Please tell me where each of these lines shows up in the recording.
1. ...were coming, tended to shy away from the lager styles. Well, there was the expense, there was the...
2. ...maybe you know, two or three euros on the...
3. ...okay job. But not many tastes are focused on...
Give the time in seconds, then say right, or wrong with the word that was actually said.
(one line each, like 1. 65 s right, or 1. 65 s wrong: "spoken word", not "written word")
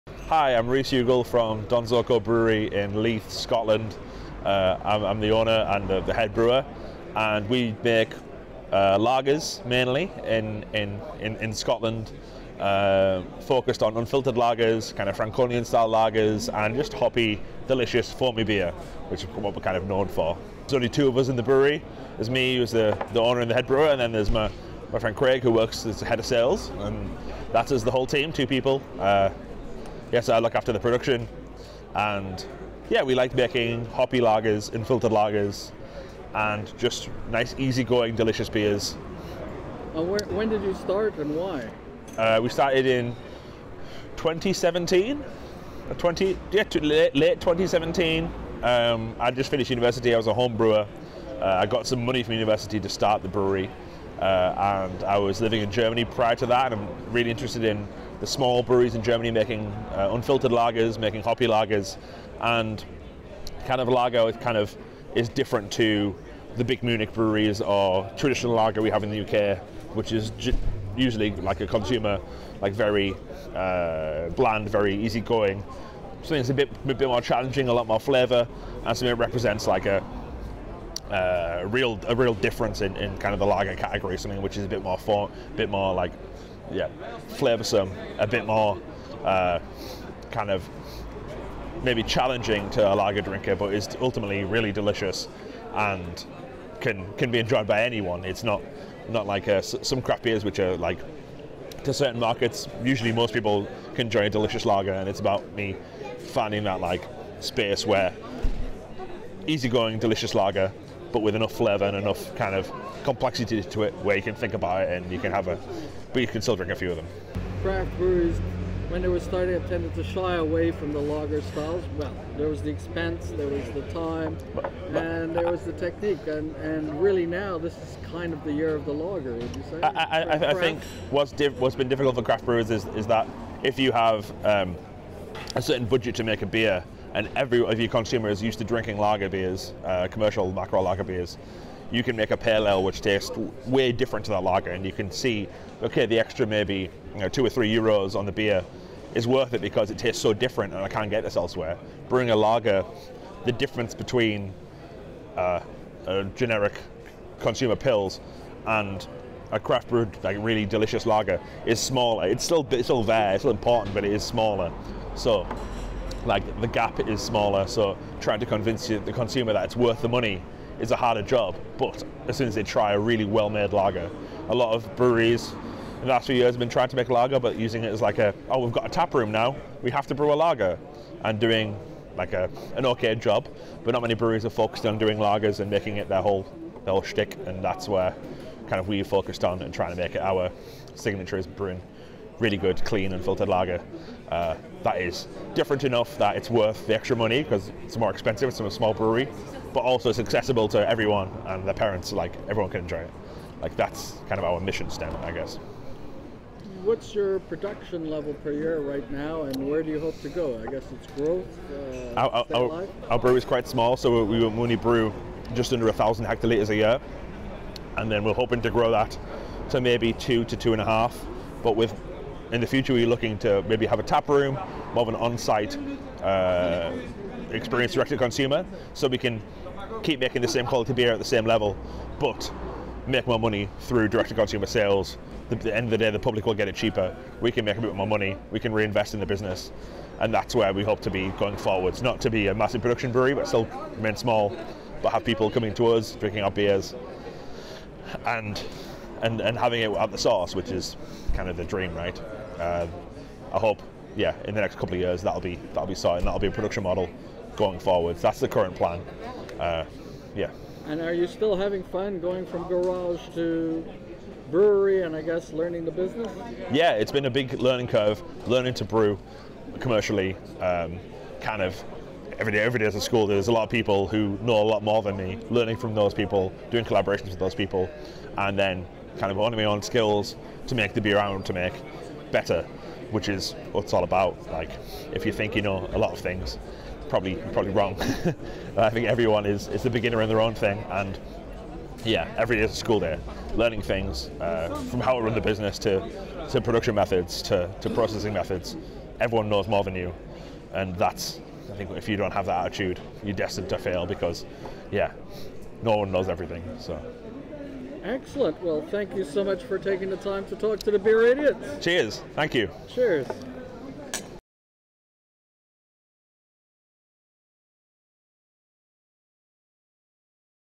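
1. 119 s wrong: "starting", not "coming"
2. 146 s right
3. 182 s wrong: "breweries", not "tastes".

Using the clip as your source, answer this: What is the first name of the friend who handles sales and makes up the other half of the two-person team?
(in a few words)
Craig.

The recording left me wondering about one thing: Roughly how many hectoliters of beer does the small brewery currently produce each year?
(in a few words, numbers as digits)
just under 1000.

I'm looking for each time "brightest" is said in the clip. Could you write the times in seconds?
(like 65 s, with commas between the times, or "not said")
not said.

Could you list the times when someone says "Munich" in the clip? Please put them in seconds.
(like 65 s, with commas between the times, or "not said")
66 s.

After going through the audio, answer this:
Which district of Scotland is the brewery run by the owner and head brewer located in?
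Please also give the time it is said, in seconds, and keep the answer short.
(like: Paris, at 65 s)
Leith, at 3 s.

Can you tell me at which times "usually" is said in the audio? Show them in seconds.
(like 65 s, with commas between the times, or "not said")
70 s, 102 s.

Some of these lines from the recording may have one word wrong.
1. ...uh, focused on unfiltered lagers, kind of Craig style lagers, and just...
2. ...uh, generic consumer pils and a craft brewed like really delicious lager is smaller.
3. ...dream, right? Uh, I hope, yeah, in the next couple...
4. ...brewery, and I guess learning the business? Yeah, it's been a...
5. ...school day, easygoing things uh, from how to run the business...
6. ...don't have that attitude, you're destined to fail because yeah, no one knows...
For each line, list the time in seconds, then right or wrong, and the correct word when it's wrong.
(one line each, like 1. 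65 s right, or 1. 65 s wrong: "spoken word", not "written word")
1. 12 s wrong: "Franconian", not "Craig"
2. 155 s right
3. 251 s right
4. 264 s right
5. 292 s wrong: "learning", not "easygoing"
6. 302 s right.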